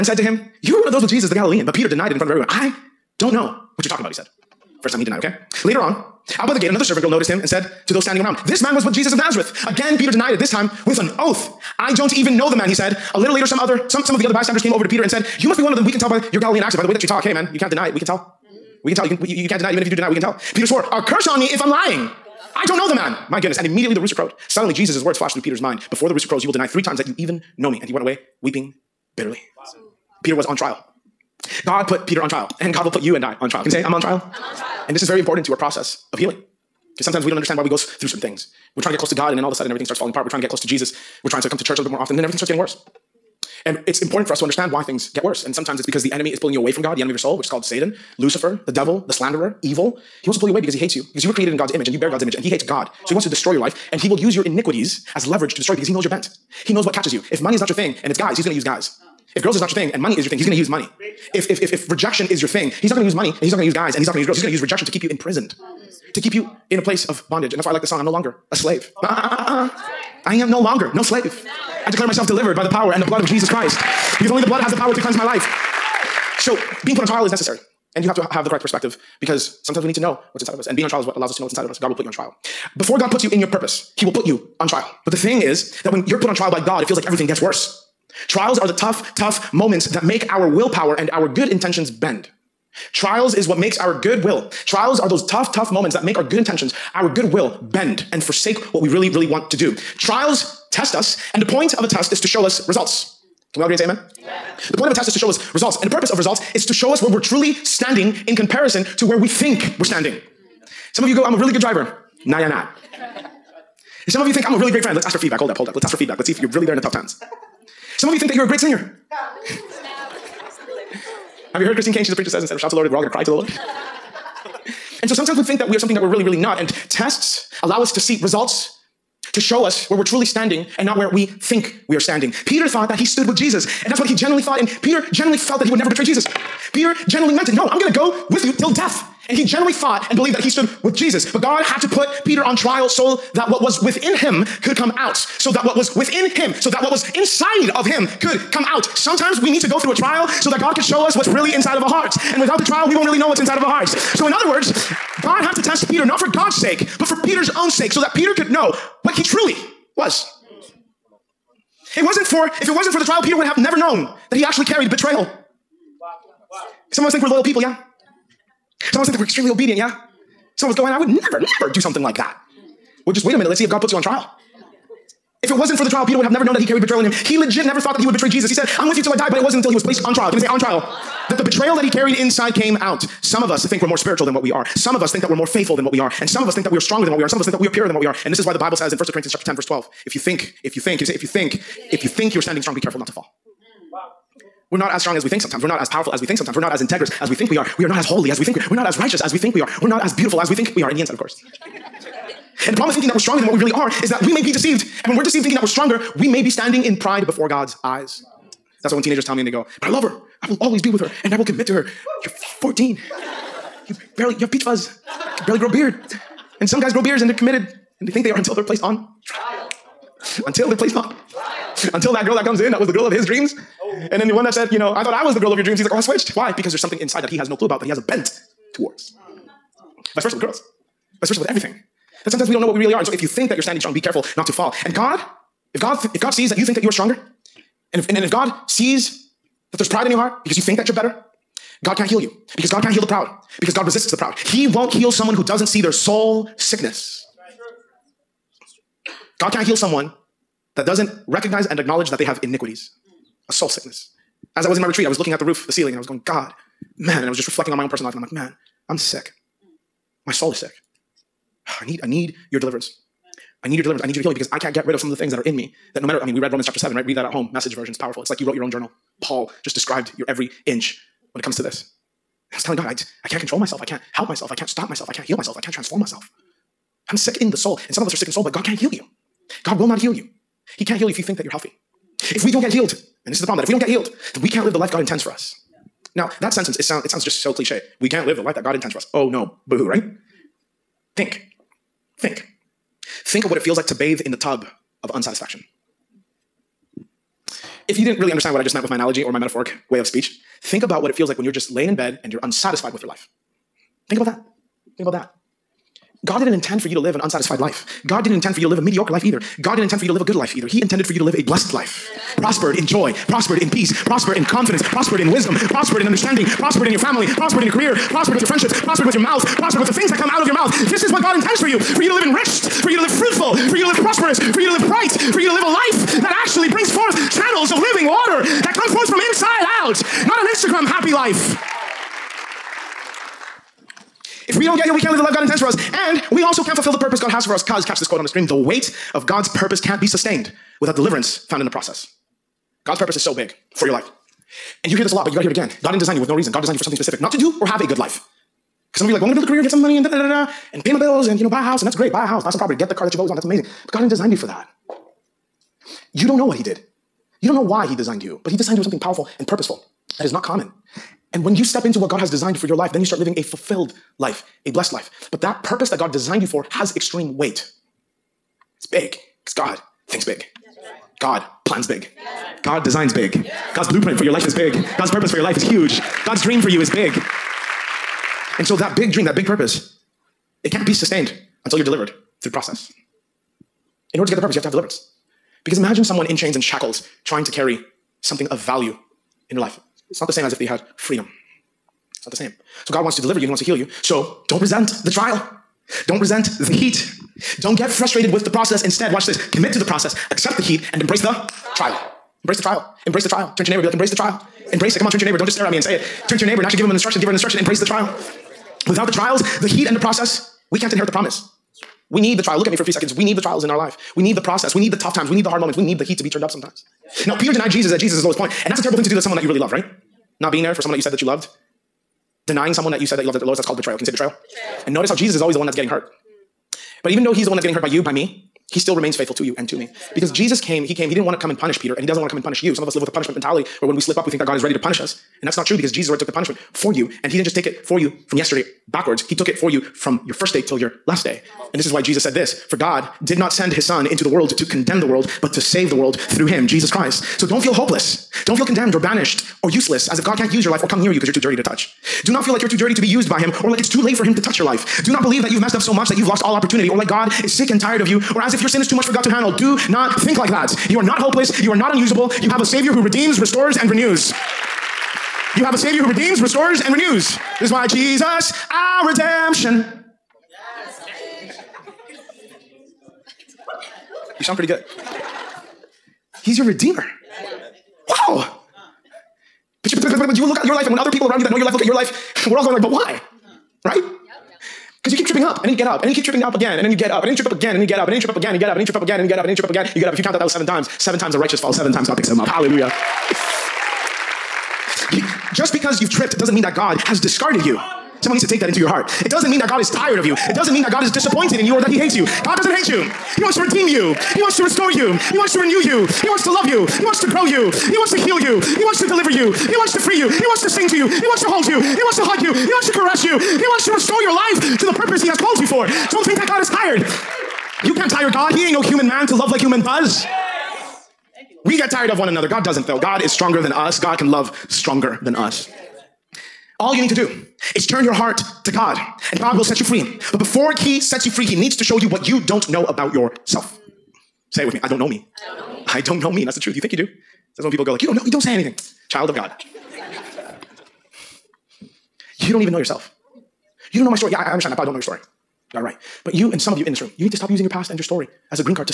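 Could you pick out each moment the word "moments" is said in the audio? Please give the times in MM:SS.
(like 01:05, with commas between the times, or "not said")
01:29, 01:35, 06:55.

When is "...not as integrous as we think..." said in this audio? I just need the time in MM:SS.
03:16.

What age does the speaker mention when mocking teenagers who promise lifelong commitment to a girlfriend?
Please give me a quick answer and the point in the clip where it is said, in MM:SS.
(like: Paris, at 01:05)
14, at 03:32.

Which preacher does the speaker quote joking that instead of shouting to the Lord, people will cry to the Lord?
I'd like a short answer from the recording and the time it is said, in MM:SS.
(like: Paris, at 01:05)
Christine Caine, at 02:01.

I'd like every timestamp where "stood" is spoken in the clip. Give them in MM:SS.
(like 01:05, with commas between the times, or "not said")
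02:13, 02:20.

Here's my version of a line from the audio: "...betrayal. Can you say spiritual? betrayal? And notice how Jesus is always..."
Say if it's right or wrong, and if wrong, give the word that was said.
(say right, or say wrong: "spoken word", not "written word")
wrong: "betrayal", not "spiritual".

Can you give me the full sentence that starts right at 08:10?
If you count out those seven times, seven times the righteous falls, seven times God picks him up.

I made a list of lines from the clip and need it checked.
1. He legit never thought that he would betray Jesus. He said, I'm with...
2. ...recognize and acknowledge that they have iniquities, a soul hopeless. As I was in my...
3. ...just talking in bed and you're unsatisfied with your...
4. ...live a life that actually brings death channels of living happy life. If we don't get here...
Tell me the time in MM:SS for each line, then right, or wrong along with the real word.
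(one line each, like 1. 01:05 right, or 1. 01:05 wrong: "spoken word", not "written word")
1. 02:57 right
2. 04:11 wrong: "sickness", not "hopeless"
3. 05:01 wrong: "laying", not "talking"
4. 05:25 wrong: "forth", not "death".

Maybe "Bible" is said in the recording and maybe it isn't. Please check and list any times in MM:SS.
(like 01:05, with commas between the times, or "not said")
03:08.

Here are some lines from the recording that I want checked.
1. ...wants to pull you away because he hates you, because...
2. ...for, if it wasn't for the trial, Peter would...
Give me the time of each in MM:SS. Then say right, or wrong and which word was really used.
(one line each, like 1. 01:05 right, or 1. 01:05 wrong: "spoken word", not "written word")
1. 00:50 right
2. 02:42 right.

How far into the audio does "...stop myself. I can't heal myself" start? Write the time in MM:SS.
04:34.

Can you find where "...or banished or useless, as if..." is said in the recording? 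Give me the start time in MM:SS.
07:28.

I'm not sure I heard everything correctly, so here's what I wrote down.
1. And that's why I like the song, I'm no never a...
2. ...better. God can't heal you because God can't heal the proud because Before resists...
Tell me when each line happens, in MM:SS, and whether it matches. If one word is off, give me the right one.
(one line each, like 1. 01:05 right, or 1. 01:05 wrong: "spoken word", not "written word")
1. 01:07 wrong: "longer", not "never"
2. 04:00 wrong: "God", not "Before".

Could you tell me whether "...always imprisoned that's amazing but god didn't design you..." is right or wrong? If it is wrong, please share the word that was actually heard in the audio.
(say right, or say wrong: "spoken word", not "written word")
wrong: "wanted", not "imprisoned".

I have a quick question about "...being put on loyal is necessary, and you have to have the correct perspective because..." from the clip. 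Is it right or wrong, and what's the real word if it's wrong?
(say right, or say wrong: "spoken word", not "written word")
wrong: "trial", not "loyal".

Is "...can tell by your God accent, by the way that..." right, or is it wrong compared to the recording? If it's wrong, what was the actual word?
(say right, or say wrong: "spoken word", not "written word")
wrong: "Galilean", not "God".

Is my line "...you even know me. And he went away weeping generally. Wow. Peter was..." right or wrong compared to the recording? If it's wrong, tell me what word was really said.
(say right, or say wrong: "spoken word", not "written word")
wrong: "bitterly", not "generally".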